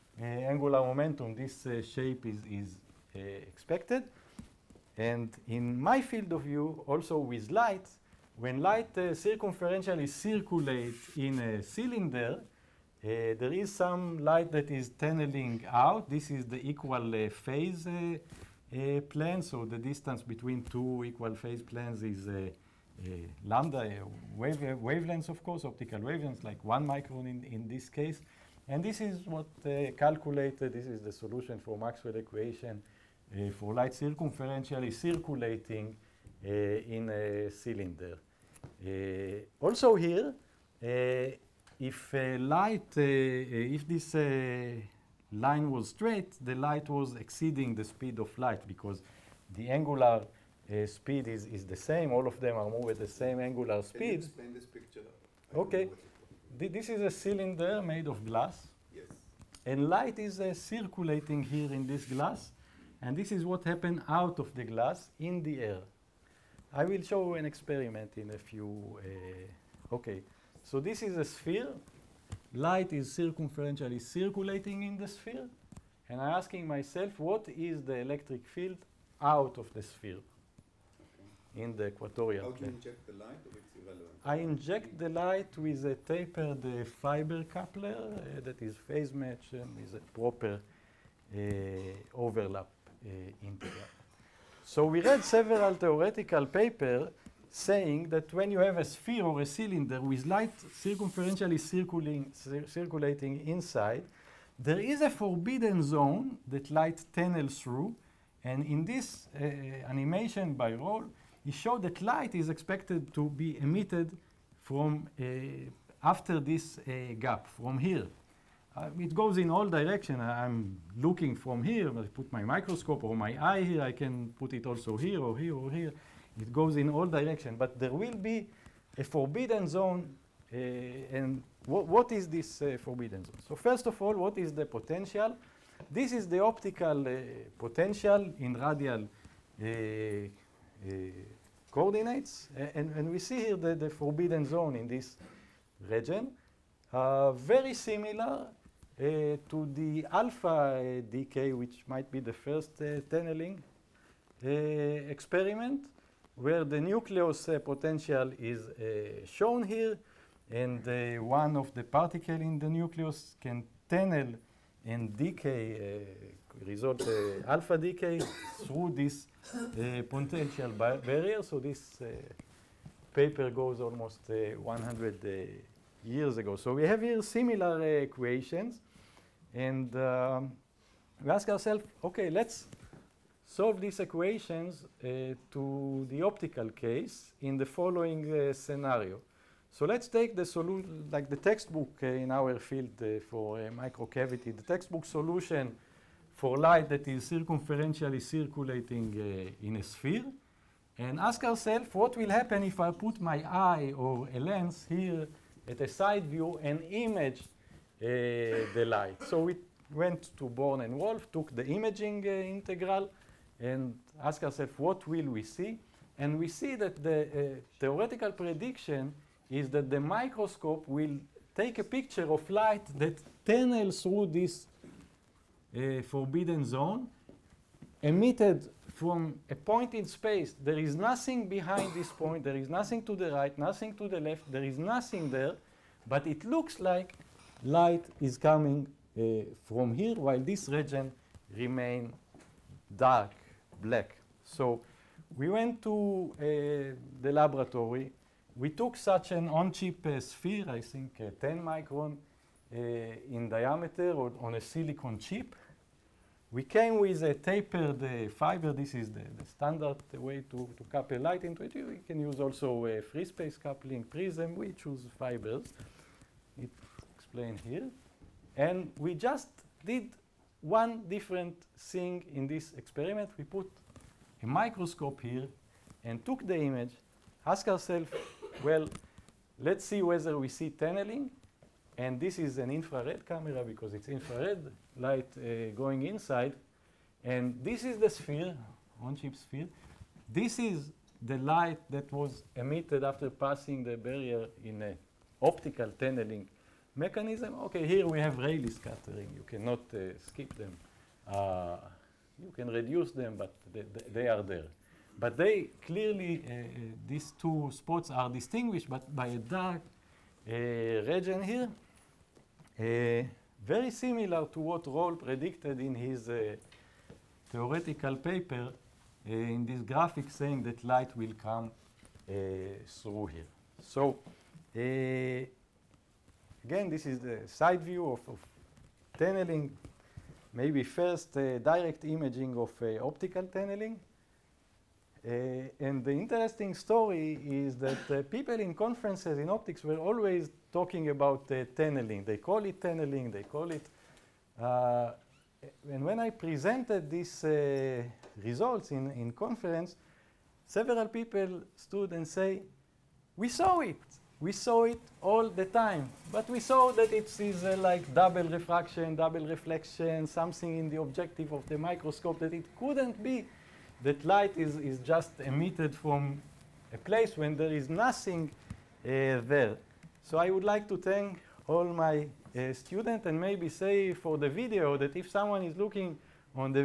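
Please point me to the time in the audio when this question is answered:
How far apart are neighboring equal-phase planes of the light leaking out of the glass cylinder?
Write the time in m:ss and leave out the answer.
0:26.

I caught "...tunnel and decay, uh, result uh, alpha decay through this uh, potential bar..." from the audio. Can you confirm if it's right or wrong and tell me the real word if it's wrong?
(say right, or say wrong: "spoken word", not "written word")
right.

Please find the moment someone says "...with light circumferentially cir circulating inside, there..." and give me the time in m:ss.
1:40.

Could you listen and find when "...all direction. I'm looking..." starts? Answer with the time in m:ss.
1:59.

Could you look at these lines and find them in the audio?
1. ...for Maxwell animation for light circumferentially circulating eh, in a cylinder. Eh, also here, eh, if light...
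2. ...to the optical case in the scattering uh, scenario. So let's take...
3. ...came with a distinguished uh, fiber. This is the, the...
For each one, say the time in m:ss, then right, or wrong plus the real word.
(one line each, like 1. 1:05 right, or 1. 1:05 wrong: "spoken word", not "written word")
1. 0:31 wrong: "equation", not "animation"
2. 3:05 wrong: "following", not "scattering"
3. 4:16 wrong: "tapered", not "distinguished".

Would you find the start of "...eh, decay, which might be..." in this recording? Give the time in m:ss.
2:30.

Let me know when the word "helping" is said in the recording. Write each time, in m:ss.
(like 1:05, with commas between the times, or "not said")
not said.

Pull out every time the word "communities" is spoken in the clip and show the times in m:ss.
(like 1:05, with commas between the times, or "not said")
not said.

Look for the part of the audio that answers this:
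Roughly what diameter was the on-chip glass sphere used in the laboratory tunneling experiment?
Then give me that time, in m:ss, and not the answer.
4:11.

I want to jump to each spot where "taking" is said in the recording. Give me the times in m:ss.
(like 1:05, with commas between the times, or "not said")
not said.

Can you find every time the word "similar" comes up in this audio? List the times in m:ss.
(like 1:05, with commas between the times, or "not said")
2:27, 2:57, 5:13.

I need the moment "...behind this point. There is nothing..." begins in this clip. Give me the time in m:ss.
3:51.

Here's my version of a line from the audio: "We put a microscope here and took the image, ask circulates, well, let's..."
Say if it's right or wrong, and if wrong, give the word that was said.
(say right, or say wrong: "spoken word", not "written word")
wrong: "ourselves", not "circulates".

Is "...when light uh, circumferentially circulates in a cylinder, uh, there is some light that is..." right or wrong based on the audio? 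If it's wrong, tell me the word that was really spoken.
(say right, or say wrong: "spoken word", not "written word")
right.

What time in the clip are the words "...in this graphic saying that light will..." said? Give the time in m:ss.
5:19.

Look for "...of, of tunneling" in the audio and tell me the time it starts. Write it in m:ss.
5:28.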